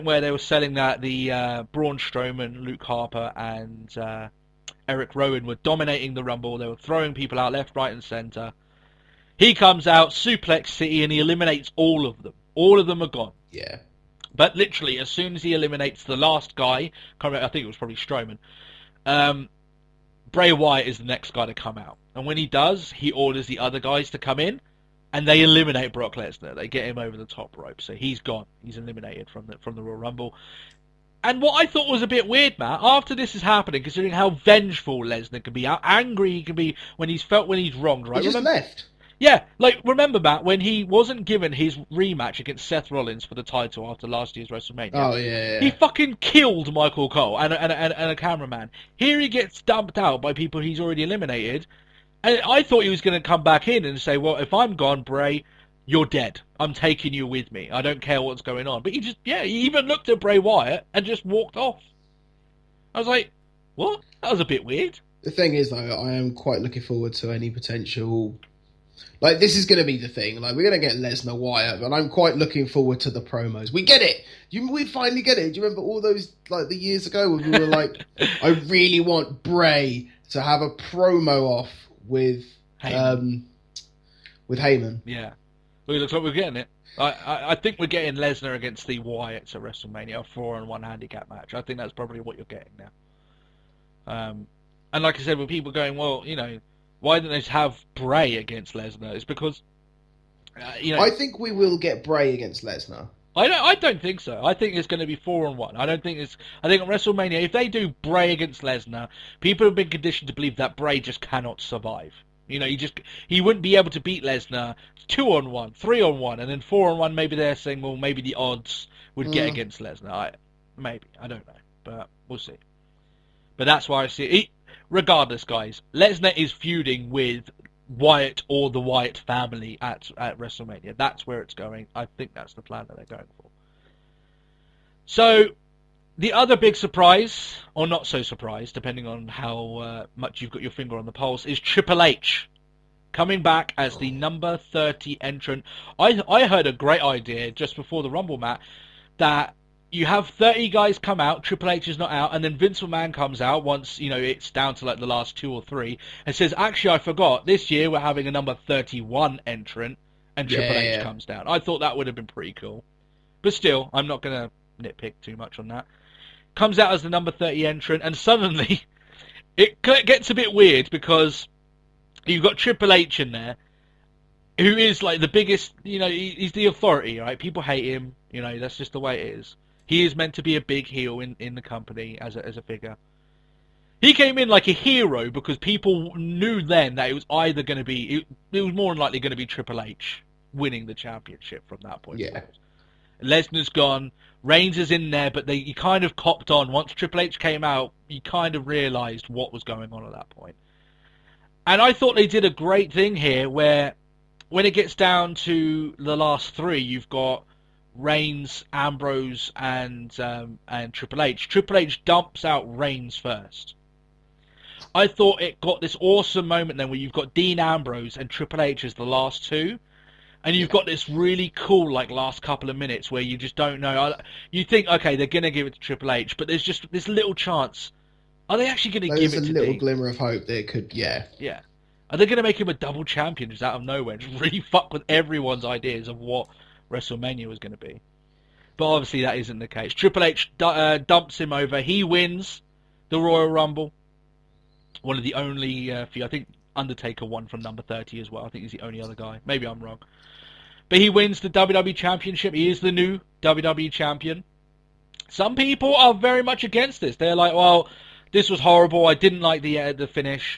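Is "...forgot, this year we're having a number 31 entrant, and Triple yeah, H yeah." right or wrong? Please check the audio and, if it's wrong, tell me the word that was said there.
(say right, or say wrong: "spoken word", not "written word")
right.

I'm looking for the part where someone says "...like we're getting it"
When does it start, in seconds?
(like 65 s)
86 s.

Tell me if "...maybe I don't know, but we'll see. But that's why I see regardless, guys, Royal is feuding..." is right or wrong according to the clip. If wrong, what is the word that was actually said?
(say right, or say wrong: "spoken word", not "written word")
wrong: "Lesnar", not "Royal".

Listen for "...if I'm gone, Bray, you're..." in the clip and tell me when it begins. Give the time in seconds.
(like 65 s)
54 s.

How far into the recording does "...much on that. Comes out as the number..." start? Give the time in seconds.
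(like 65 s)
165 s.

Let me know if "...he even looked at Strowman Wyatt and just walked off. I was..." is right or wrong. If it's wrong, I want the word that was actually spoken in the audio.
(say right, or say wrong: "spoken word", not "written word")
wrong: "Bray", not "Strowman".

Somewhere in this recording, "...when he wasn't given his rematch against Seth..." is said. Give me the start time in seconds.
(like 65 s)
40 s.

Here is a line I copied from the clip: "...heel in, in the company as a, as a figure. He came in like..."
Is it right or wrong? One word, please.
right.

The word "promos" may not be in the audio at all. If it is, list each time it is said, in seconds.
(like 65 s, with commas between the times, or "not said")
73 s, 80 s.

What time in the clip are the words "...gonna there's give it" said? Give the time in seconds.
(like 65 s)
229 s.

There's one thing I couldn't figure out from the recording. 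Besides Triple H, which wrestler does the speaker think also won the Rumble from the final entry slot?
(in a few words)
Undertaker.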